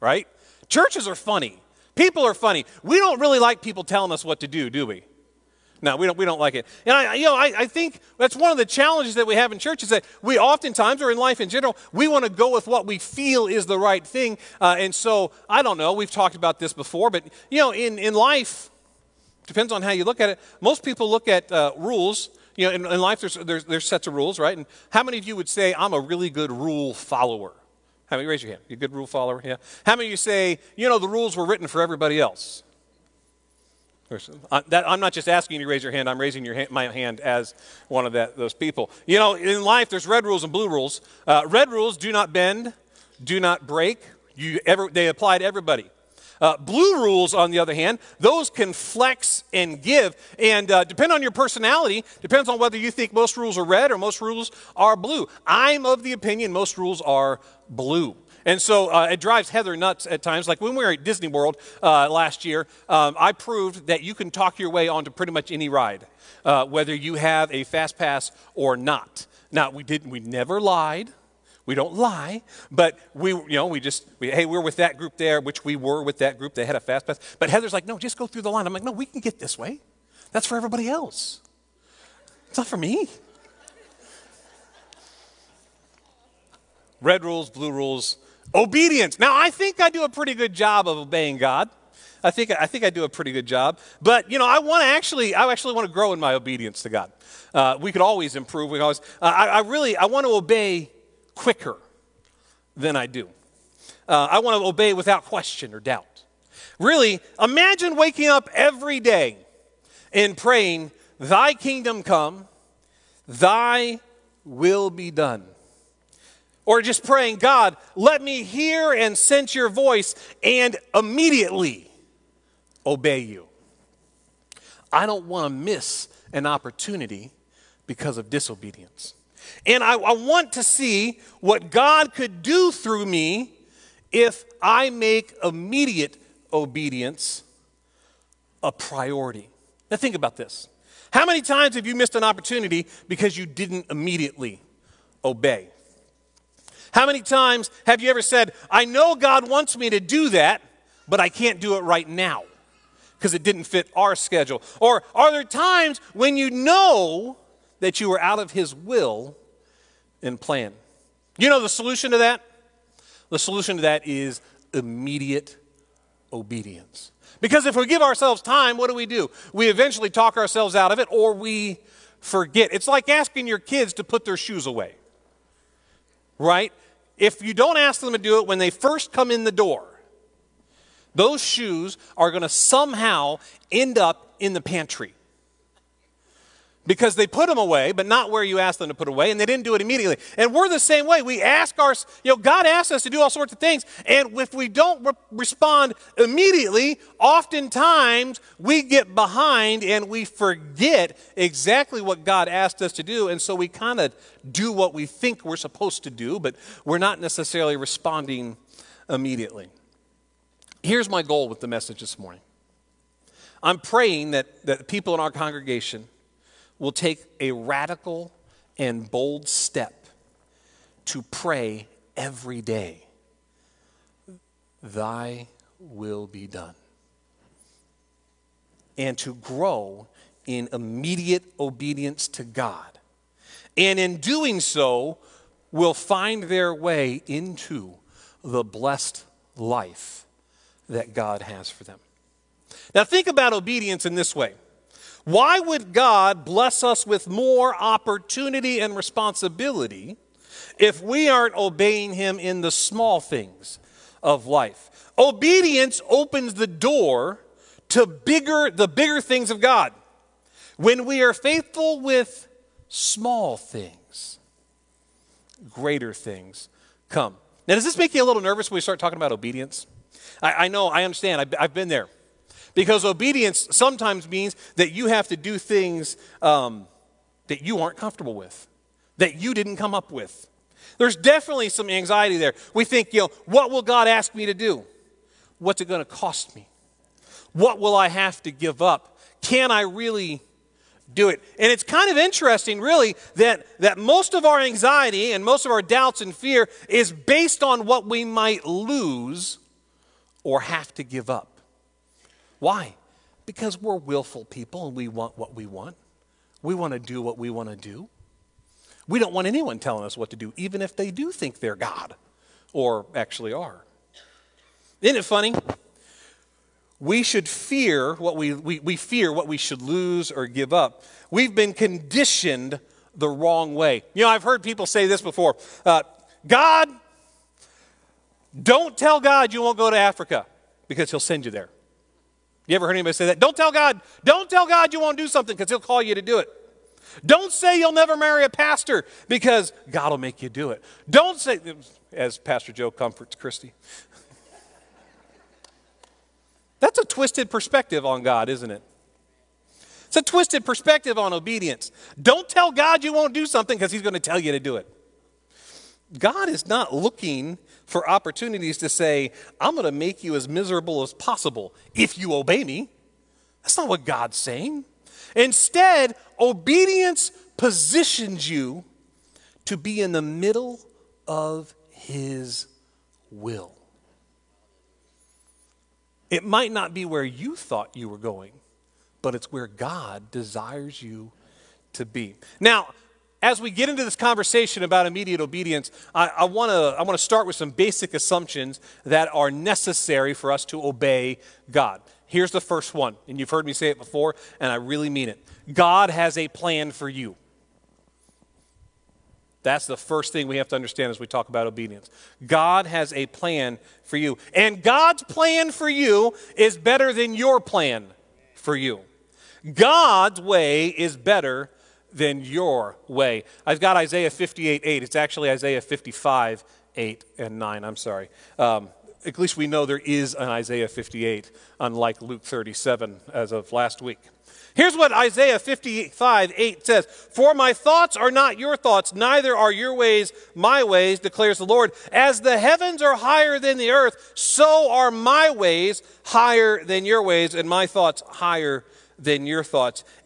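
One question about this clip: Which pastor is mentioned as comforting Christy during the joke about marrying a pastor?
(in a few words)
Pastor Joe.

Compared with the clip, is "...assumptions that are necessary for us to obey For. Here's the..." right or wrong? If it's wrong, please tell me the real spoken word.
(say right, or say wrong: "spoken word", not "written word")
wrong: "God", not "For".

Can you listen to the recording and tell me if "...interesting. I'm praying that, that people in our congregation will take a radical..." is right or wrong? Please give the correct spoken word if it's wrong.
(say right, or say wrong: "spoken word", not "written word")
wrong: "morning", not "interesting".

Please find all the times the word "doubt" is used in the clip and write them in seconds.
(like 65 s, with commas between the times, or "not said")
105 s, 295 s.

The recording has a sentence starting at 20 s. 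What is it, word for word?
Most people look at uh, rules.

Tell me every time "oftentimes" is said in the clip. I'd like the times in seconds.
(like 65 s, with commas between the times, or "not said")
10 s, 197 s.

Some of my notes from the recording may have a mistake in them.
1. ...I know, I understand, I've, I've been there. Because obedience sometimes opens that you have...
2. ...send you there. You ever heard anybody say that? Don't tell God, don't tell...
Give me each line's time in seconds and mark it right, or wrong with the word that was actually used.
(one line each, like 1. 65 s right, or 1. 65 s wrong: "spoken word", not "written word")
1. 270 s wrong: "means", not "opens"
2. 331 s right.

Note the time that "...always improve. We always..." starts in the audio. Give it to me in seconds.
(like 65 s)
98 s.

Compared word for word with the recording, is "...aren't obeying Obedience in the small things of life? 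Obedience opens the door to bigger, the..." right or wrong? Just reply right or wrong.
wrong.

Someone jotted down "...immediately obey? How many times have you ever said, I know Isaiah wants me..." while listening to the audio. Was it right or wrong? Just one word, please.
wrong.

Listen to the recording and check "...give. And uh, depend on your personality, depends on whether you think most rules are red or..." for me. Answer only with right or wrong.
right.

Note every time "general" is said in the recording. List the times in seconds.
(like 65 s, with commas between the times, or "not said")
11 s.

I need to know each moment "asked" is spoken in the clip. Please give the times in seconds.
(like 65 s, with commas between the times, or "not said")
188 s, 202 s.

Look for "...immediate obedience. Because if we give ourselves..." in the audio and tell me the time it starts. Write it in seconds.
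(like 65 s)
164 s.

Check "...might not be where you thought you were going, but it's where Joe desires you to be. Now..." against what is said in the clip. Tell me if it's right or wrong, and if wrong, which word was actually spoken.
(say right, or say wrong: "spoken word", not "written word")
wrong: "God", not "Joe".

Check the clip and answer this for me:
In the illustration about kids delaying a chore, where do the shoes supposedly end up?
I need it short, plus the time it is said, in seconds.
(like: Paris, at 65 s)
The pantry, at 184 s.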